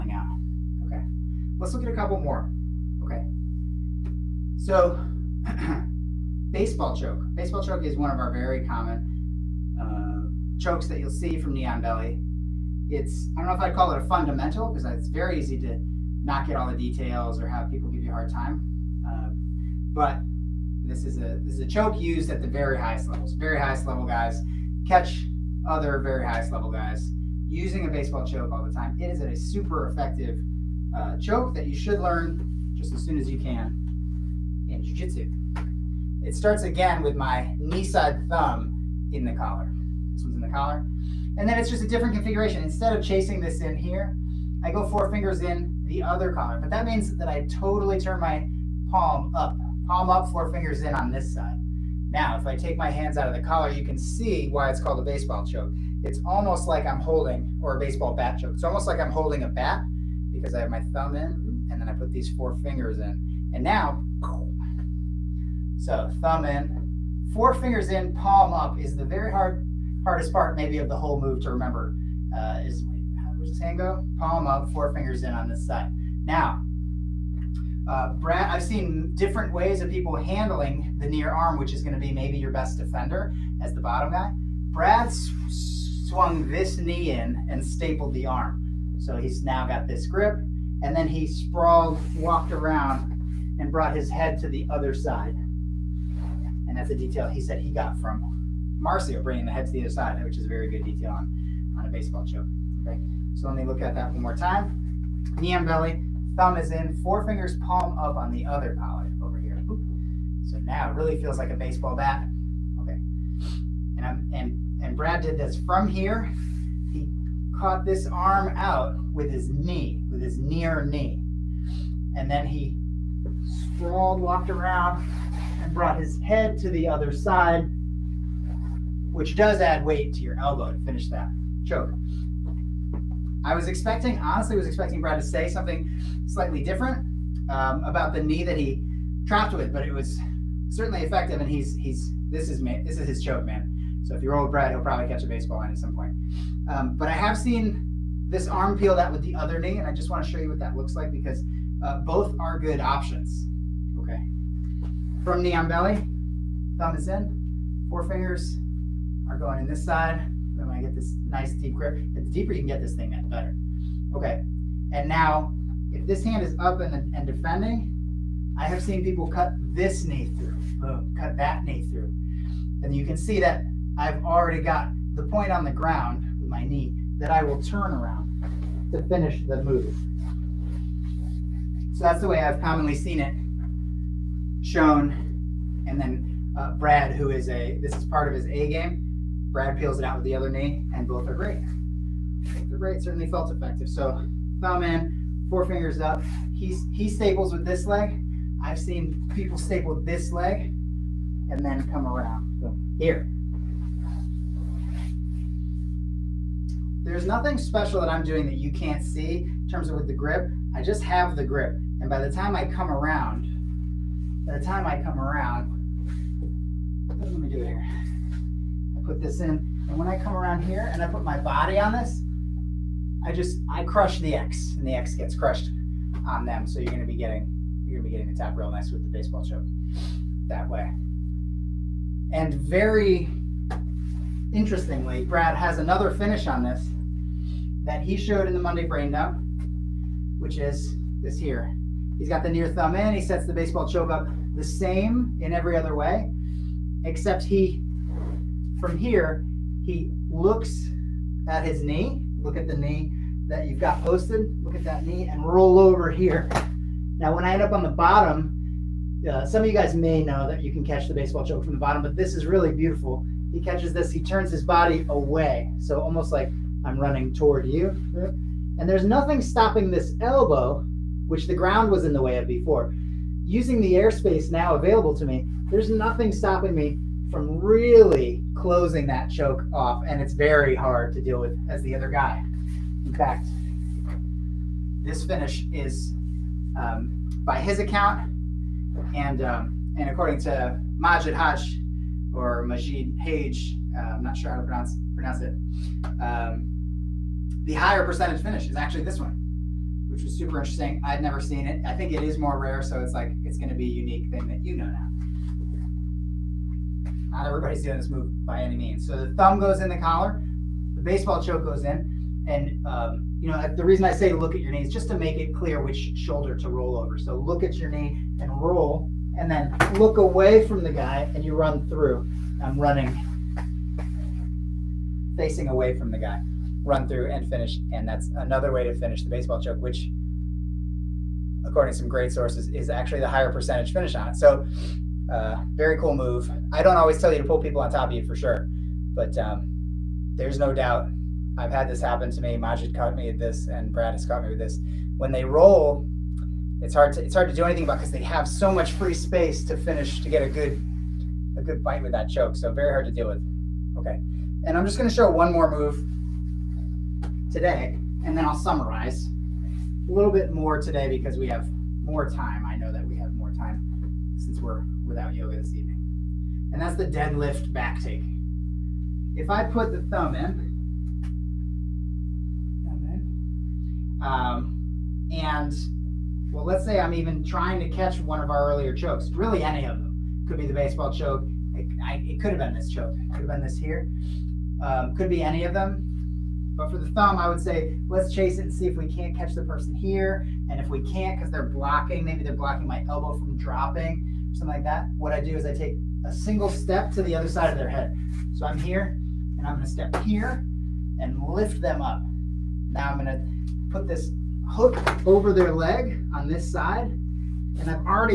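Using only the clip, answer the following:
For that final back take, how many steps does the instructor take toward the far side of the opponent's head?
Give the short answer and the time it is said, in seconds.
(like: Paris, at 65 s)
1, at 396 s.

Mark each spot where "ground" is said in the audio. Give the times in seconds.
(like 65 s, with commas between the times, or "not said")
175 s, 271 s.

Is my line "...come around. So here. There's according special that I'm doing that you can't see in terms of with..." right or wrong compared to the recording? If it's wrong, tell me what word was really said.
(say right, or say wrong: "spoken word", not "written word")
wrong: "nothing", not "according".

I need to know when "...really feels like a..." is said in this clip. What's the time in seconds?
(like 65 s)
110 s.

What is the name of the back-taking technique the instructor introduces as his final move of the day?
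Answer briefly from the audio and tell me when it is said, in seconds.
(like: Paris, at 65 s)
Deadlift back take, at 367 s.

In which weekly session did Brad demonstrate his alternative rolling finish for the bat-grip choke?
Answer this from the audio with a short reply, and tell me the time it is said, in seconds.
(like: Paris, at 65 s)
Monday brain dump, at 238 s.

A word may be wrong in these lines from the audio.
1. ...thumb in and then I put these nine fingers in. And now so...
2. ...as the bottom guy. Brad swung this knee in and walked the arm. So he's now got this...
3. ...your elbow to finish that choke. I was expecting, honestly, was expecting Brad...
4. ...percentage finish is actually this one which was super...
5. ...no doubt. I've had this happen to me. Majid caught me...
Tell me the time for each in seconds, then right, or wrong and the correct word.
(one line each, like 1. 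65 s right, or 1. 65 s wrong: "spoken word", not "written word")
1. 60 s wrong: "four", not "nine"
2. 83 s wrong: "stapled", not "walked"
3. 130 s right
4. 298 s right
5. 340 s right.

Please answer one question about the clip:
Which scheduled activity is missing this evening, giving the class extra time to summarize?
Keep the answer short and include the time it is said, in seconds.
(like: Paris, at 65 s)
Yoga, at 365 s.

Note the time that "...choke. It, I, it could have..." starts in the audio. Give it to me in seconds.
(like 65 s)
381 s.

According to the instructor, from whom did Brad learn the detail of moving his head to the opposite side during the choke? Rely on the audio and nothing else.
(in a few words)
Marcio.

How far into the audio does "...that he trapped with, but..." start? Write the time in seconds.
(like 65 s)
138 s.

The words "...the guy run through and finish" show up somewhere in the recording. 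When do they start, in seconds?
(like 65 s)
326 s.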